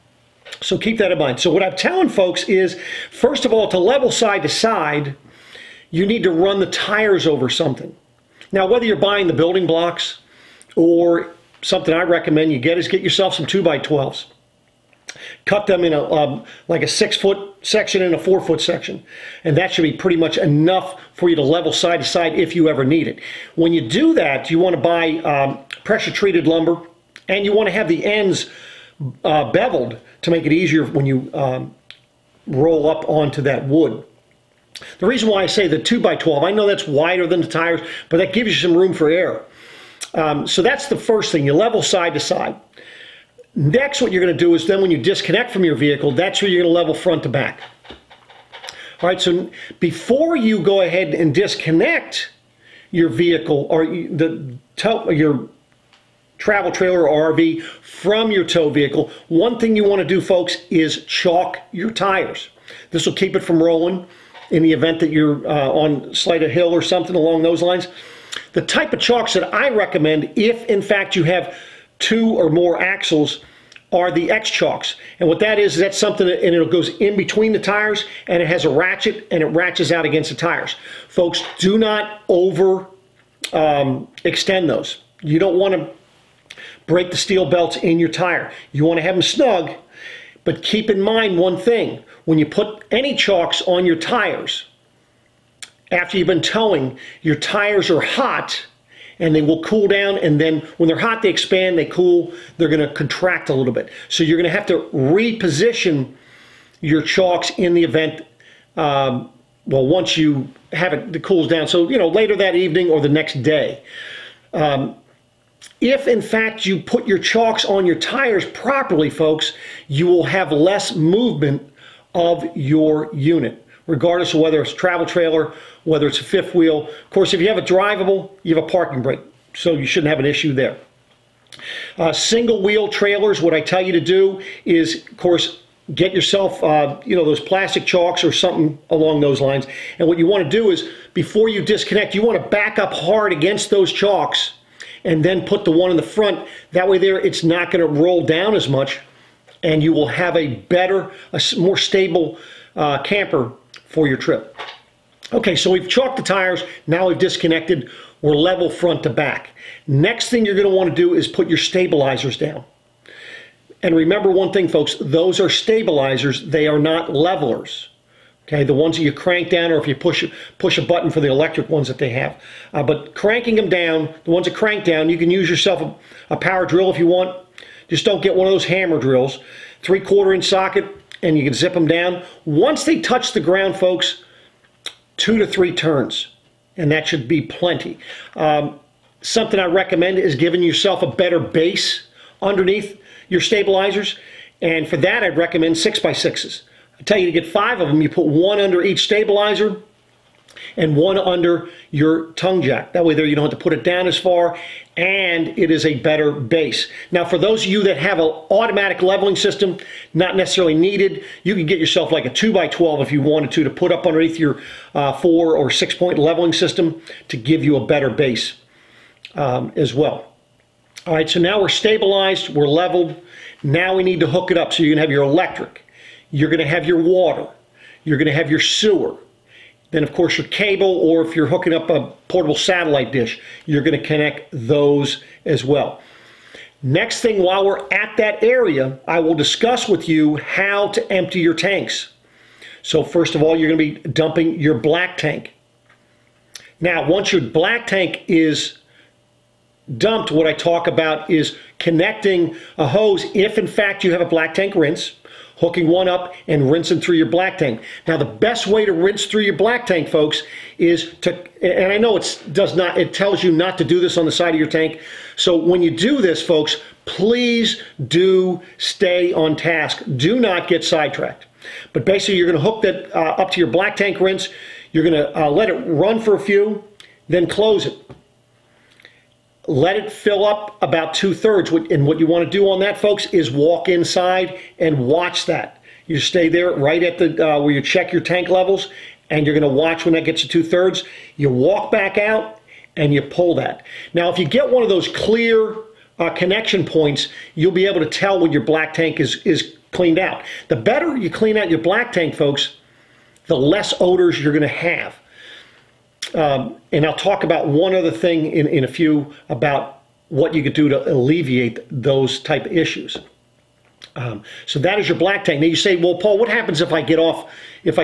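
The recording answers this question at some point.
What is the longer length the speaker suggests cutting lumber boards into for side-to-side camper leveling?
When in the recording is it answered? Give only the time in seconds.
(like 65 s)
16 s.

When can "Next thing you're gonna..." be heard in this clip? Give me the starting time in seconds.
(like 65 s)
159 s.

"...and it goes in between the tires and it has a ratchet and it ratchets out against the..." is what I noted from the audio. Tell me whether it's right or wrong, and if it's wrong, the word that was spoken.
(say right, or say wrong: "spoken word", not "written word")
right.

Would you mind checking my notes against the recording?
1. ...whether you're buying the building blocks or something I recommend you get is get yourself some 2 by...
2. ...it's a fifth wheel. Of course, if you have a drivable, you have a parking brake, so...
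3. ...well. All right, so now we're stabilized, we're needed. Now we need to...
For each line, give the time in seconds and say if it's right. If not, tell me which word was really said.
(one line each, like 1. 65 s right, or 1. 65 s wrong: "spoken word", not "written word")
1. 8 s right
2. 126 s right
3. 219 s wrong: "leveled", not "needed".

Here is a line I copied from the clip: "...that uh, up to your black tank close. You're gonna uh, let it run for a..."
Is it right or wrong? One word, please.
wrong.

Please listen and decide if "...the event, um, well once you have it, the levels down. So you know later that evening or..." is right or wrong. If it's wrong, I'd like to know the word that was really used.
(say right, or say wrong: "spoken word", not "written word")
wrong: "cools", not "levels".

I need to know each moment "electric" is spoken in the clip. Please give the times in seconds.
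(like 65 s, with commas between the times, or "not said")
171 s, 225 s.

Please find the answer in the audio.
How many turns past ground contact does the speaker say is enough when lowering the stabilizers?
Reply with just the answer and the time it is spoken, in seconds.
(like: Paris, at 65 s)
2 to 3 turns, at 185 s.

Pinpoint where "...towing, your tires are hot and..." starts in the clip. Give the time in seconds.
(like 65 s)
96 s.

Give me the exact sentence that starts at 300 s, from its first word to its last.
The better you clean out your black tank, folks, the less odors you're going to have.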